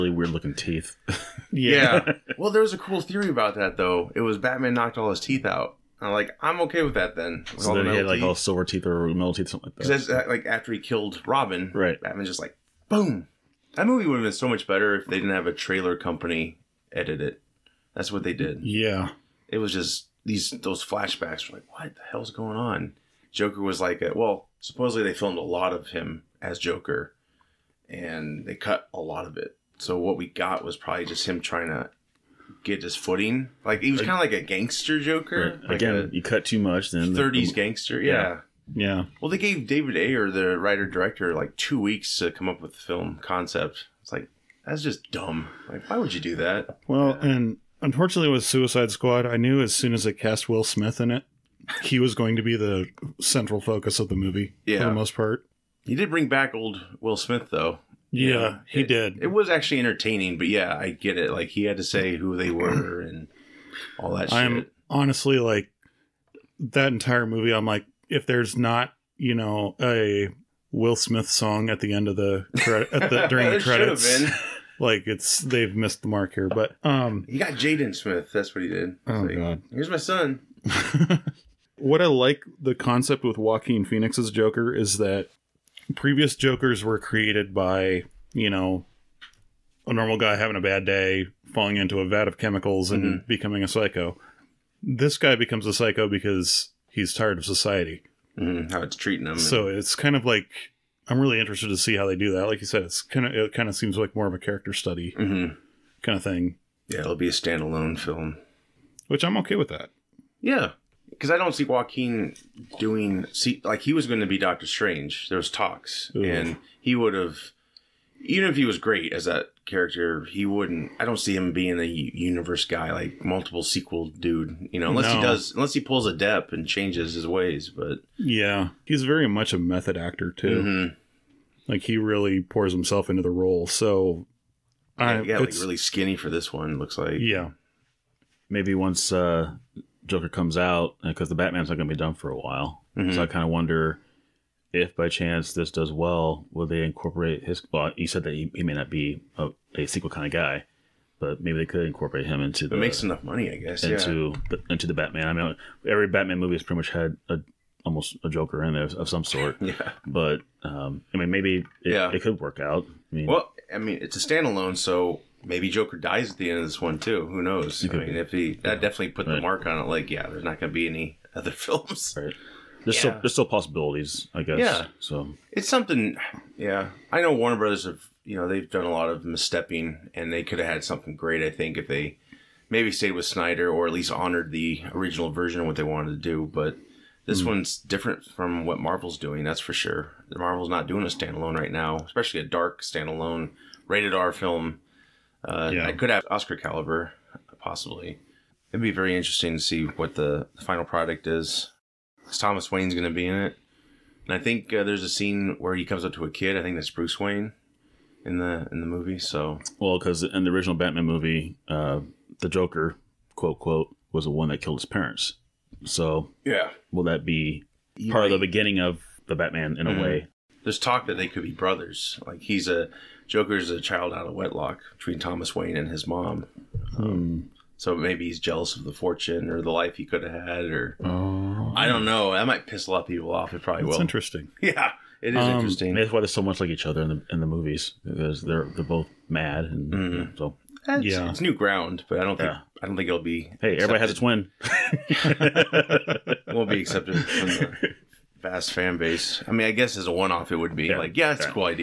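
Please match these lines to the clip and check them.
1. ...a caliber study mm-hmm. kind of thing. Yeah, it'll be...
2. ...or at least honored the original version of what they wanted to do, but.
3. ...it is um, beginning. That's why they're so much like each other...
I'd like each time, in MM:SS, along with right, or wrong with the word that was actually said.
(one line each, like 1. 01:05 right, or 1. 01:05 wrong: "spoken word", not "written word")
1. 01:44 wrong: "character", not "caliber"
2. 03:03 right
3. 03:55 wrong: "interesting", not "beginning".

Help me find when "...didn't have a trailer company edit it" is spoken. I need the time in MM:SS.
00:15.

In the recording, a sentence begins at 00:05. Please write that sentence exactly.
I'm like, I'm okay with that then.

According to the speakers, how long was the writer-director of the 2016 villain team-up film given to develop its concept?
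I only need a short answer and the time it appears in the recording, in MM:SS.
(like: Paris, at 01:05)
2 weeks, at 00:41.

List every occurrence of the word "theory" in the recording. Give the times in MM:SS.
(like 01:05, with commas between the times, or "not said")
00:02.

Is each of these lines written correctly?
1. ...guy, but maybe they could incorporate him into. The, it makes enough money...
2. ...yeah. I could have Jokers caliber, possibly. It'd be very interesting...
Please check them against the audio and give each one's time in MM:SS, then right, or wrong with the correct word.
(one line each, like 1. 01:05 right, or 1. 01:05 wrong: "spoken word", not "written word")
1. 02:30 right
2. 03:15 wrong: "Oscar", not "Jokers".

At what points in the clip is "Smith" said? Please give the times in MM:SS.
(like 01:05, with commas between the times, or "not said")
00:50, 00:57, 01:10, 01:17.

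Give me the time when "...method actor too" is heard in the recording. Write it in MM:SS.
02:09.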